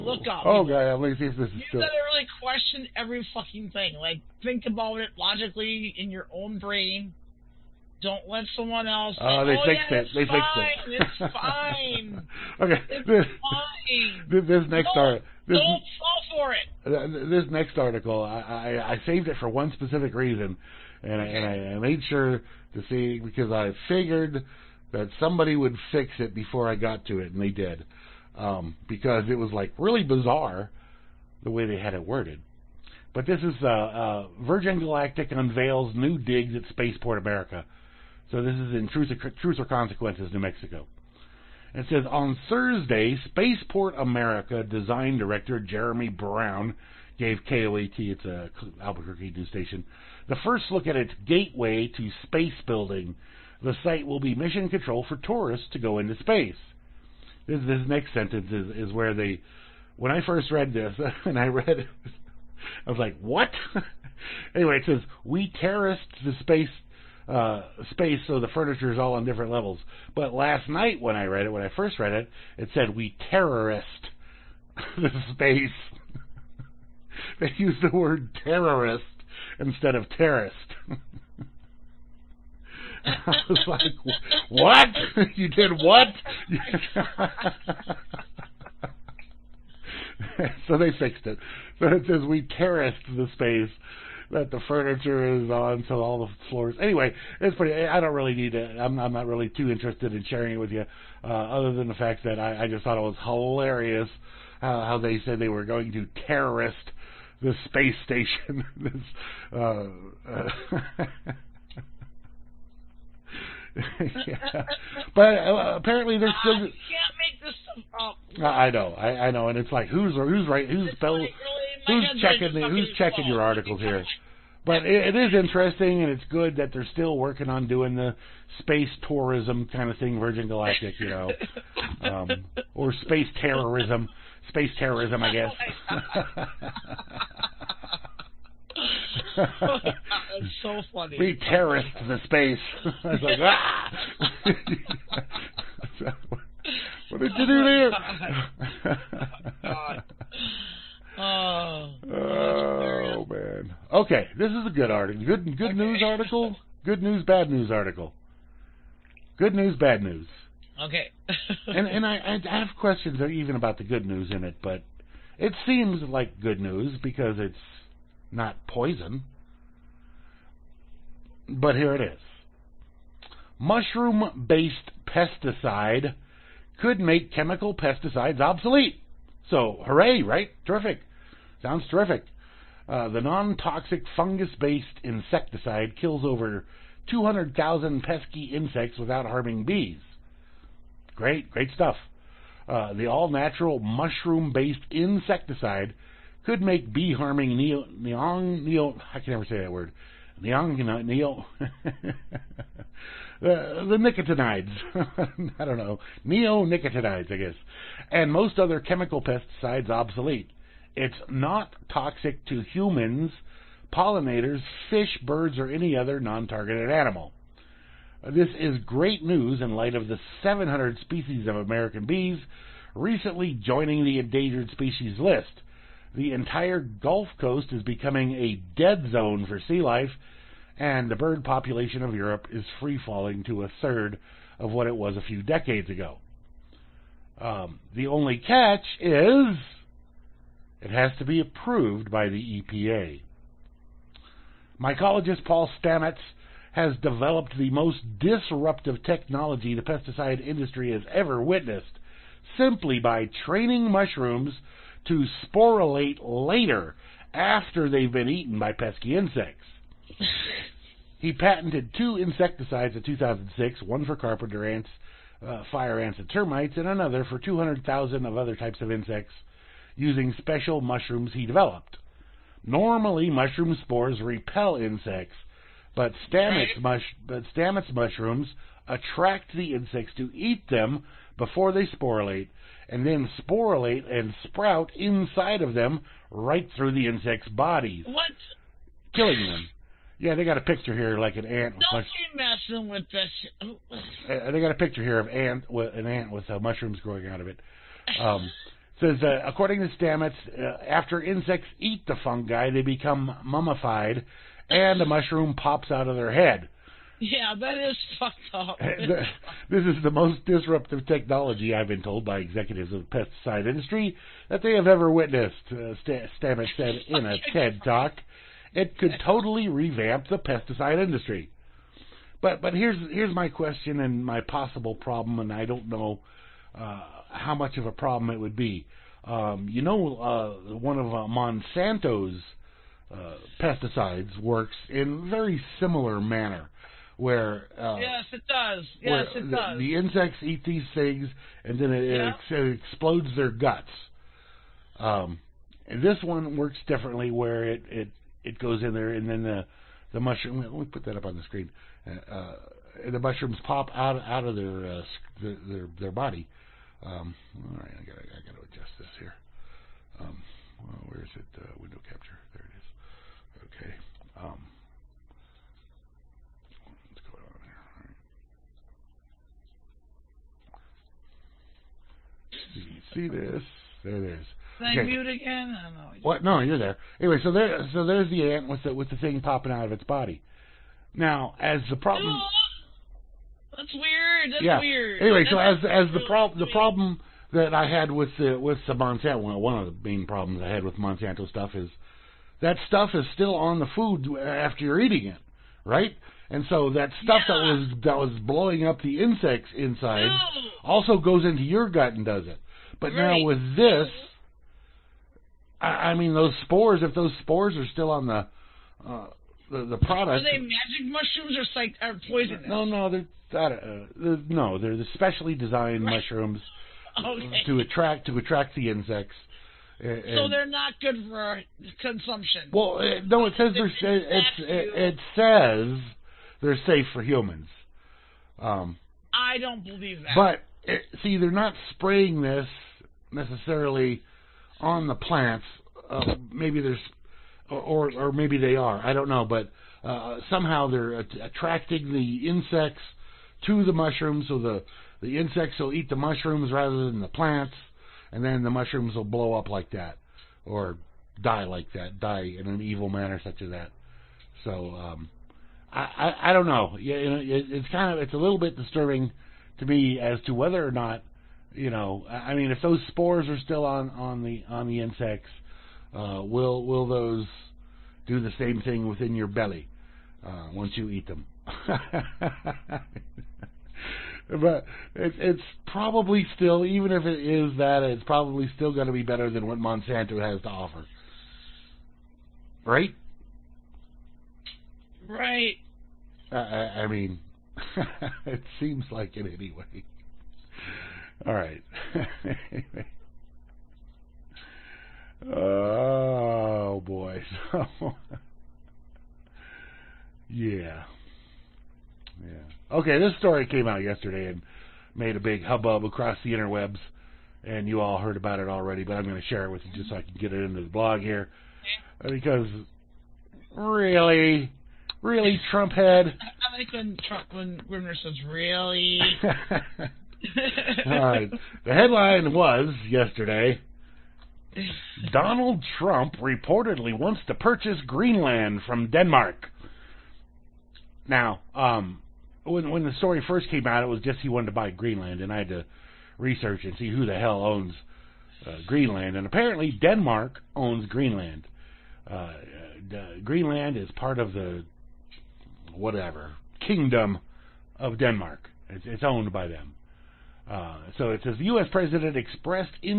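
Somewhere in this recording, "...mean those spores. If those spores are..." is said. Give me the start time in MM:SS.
06:46.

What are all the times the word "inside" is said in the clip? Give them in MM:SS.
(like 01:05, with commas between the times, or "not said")
04:44, 06:39.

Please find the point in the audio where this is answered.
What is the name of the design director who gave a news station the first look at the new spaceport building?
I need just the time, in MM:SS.
00:45.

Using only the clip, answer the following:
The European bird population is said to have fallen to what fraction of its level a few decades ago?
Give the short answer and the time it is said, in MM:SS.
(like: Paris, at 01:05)
a third, at 03:53.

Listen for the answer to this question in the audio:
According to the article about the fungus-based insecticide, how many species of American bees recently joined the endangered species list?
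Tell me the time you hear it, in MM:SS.
03:40.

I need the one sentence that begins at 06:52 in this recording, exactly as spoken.
No, no, they're uh, they're, no, they're the specially designed right.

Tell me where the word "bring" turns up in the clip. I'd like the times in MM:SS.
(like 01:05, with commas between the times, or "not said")
not said.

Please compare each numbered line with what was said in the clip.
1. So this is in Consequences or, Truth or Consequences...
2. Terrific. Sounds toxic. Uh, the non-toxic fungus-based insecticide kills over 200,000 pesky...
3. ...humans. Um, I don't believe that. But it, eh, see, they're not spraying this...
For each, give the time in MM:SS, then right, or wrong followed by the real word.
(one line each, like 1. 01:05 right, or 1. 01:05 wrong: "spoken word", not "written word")
1. 00:38 wrong: "Truth", not "Consequences"
2. 03:00 wrong: "terrific", not "toxic"
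3. 07:07 right.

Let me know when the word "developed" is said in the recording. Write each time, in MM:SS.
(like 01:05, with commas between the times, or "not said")
04:07, 04:31.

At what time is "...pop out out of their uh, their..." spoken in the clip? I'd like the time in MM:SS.
05:53.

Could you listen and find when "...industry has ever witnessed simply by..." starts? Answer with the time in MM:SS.
04:10.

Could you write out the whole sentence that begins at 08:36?
I like when Trump when Grimnir says really.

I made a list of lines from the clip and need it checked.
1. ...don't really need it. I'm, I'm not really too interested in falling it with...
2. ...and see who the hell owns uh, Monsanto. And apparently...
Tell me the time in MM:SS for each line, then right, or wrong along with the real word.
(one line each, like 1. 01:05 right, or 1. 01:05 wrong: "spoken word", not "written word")
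1. 01:37 wrong: "sharing", not "falling"
2. 08:56 wrong: "Greenland", not "Monsanto".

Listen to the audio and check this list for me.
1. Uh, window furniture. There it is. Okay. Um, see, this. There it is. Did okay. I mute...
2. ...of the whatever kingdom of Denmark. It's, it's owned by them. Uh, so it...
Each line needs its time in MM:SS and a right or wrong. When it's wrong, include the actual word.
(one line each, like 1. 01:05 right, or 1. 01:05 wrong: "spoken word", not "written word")
1. 06:01 wrong: "capture", not "furniture"
2. 09:04 right.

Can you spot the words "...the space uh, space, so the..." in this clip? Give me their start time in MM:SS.
01:06.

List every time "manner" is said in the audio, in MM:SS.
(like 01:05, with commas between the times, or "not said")
05:36, 07:33.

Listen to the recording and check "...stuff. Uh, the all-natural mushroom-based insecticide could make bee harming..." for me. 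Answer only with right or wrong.
right.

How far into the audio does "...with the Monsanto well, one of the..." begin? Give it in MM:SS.
06:28.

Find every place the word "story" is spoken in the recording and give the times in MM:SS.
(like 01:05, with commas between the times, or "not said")
08:23, 08:53.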